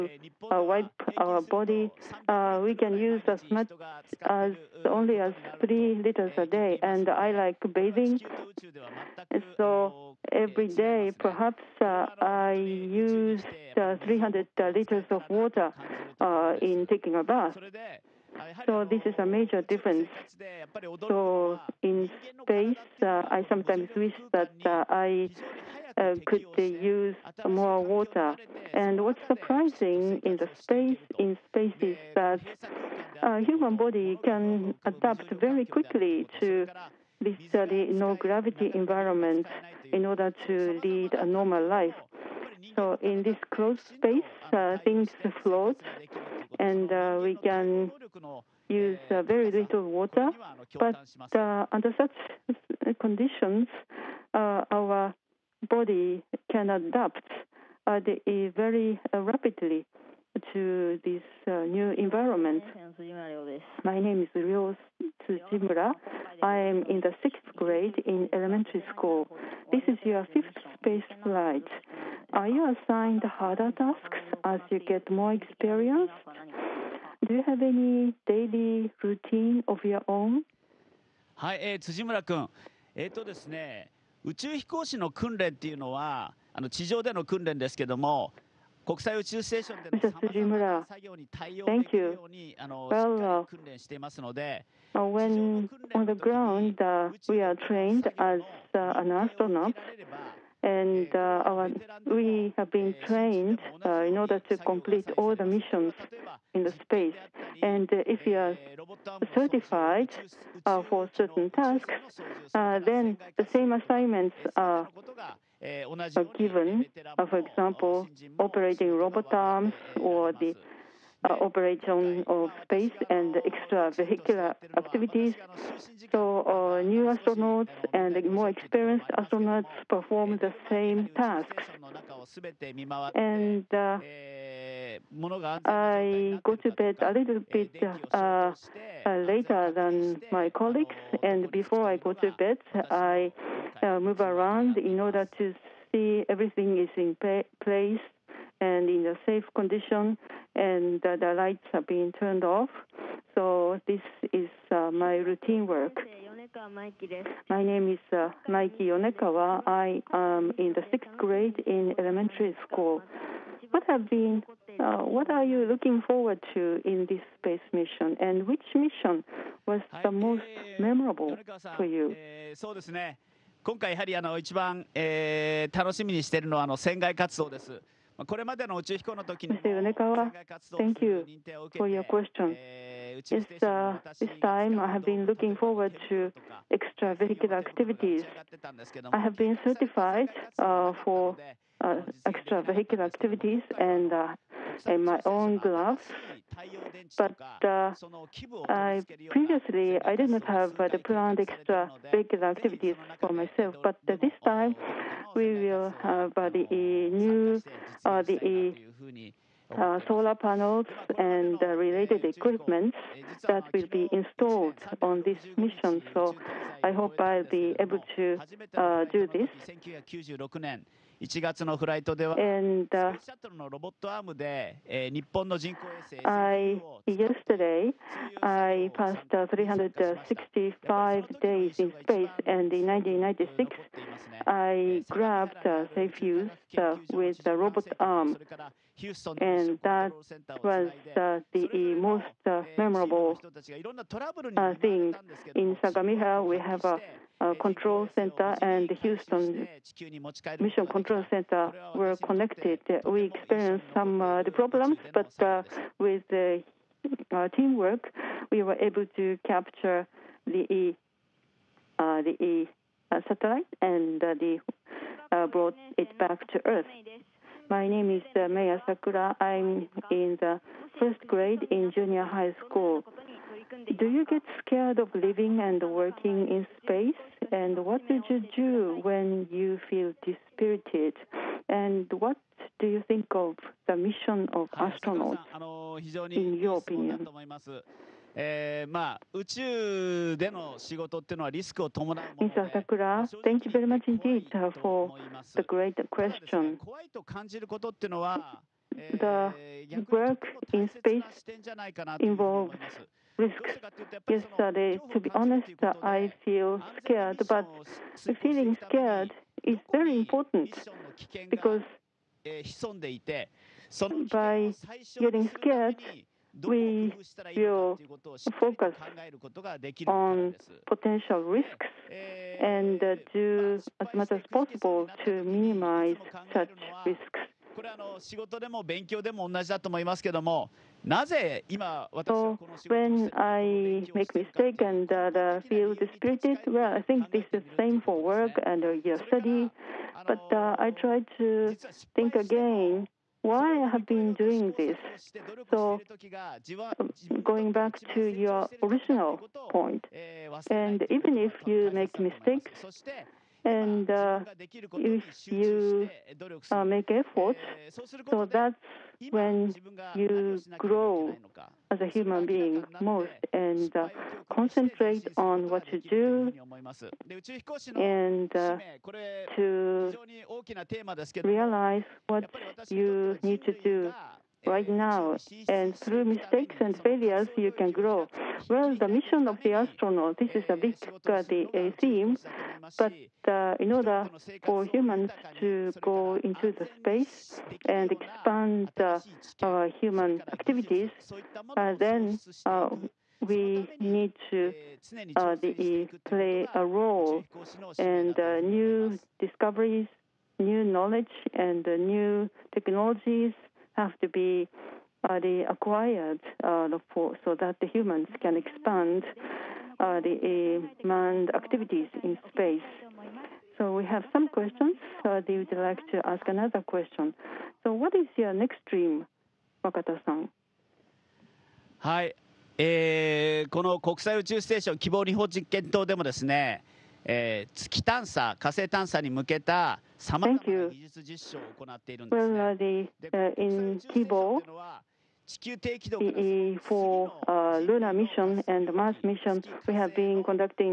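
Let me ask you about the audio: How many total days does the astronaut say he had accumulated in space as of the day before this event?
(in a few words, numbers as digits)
365.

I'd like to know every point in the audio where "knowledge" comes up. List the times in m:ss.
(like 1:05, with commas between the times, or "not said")
6:40.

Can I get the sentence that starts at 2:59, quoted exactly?
Yonekawa, thank you for your question.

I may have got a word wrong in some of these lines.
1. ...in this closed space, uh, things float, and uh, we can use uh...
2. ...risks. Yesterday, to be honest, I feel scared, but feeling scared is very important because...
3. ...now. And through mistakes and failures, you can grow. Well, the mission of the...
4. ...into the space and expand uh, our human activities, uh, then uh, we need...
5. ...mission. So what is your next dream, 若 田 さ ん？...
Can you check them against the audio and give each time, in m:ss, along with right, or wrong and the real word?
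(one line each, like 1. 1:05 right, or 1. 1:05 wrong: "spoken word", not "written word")
1. 0:42 right
2. 5:03 right
3. 6:14 right
4. 6:26 right
5. 6:56 wrong: "question", not "mission".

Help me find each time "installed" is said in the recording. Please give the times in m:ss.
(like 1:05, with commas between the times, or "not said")
3:34.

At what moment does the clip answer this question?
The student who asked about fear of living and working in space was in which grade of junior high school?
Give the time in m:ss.
4:30.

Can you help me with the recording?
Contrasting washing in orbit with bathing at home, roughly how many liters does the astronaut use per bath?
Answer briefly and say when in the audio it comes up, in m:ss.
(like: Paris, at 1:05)
300 liters, at 0:14.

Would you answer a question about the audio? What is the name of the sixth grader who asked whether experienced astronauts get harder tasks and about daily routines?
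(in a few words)
Ryo Tsujimura.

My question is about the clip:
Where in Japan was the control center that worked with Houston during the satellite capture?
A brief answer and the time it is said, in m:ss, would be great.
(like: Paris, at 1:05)
Sagamihara, at 4:05.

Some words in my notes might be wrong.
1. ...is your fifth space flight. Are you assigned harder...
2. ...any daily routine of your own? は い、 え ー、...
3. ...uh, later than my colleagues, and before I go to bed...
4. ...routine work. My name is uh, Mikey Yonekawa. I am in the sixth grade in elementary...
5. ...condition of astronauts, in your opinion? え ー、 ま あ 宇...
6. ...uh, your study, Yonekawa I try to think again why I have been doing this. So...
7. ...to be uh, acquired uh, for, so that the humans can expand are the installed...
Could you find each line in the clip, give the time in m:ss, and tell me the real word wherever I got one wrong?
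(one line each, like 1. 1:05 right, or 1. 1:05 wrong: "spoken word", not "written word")
1. 1:09 right
2. 1:17 right
3. 2:18 right
4. 2:35 right
5. 4:43 wrong: "mission", not "condition"
6. 5:38 wrong: "But", not "Yonekawa"
7. 6:44 wrong: "manned", not "installed".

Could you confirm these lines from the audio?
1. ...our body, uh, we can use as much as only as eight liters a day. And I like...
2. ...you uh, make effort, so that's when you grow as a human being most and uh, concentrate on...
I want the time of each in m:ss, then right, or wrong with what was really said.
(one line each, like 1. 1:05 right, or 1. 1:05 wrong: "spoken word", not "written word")
1. 0:01 wrong: "three", not "eight"
2. 5:55 right.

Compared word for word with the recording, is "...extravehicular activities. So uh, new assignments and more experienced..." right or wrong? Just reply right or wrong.
wrong.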